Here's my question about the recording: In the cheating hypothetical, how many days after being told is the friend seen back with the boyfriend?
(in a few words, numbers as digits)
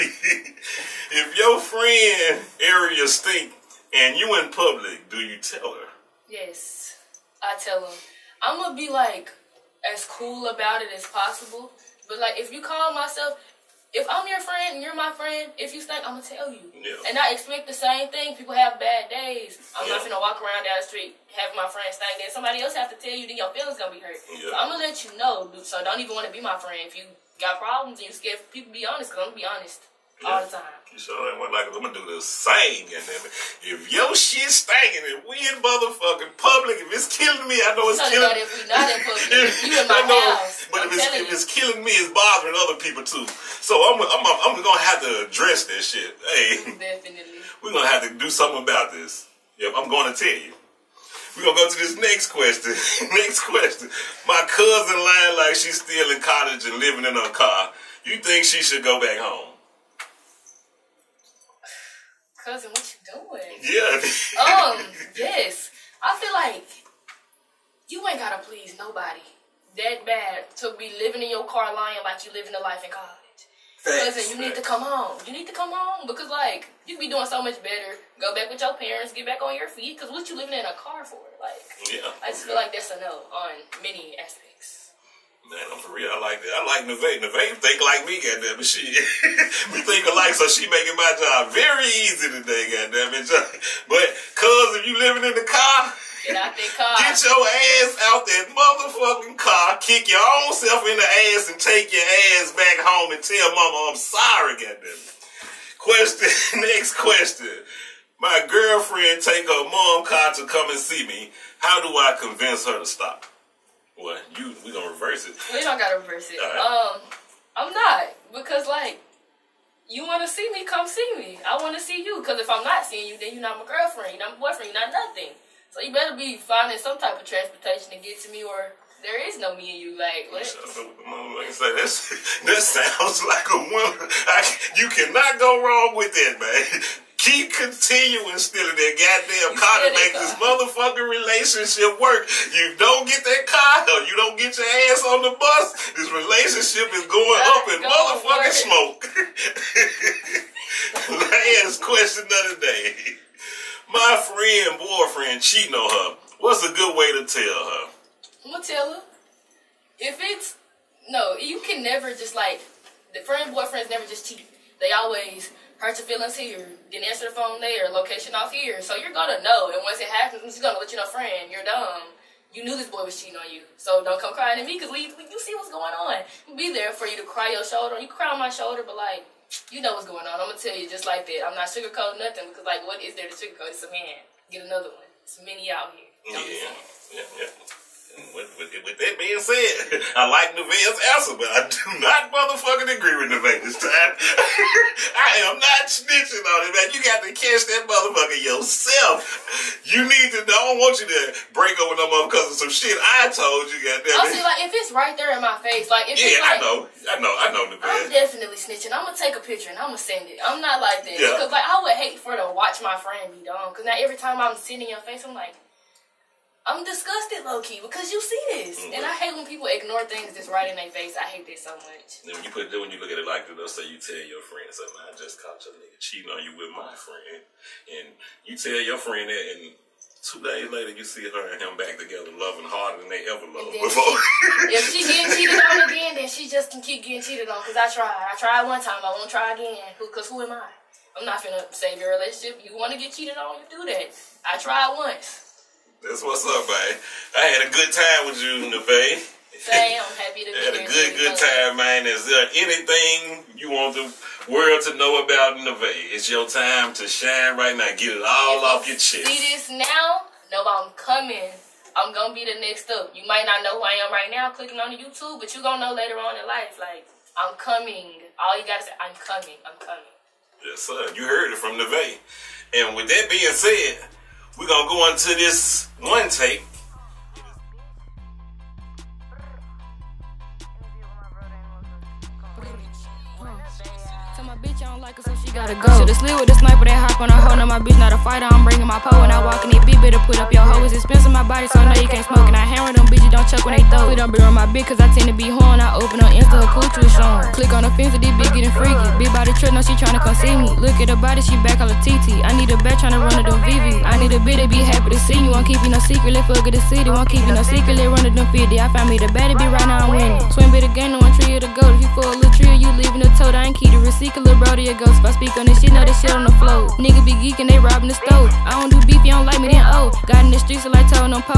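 2.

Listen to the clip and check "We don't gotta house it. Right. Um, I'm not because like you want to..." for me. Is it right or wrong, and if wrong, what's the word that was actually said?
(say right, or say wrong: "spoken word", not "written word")
wrong: "reverse", not "house".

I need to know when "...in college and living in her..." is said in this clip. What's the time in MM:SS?
00:56.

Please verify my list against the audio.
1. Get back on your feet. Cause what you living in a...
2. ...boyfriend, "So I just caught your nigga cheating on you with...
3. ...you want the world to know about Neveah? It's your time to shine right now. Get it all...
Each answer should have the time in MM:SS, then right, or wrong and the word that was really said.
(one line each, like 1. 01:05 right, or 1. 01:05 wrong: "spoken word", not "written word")
1. 01:19 right
2. 03:44 wrong: "friend", not "boyfriend"
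3. 04:13 right.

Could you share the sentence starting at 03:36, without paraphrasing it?
I'm disgusted, low key, because you see this, mm-hmm.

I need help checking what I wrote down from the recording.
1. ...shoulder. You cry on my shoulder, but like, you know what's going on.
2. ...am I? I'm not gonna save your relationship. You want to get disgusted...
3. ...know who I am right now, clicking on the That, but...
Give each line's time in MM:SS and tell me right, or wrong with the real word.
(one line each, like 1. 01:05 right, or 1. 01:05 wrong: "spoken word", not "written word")
1. 02:57 right
2. 04:00 wrong: "cheated", not "disgusted"
3. 04:23 wrong: "YouTube", not "That".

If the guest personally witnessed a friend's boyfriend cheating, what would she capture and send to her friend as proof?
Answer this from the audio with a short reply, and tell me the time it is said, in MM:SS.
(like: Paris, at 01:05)
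a picture, at 03:29.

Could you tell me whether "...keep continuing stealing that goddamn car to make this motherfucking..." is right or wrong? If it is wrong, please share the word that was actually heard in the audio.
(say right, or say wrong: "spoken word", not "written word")
right.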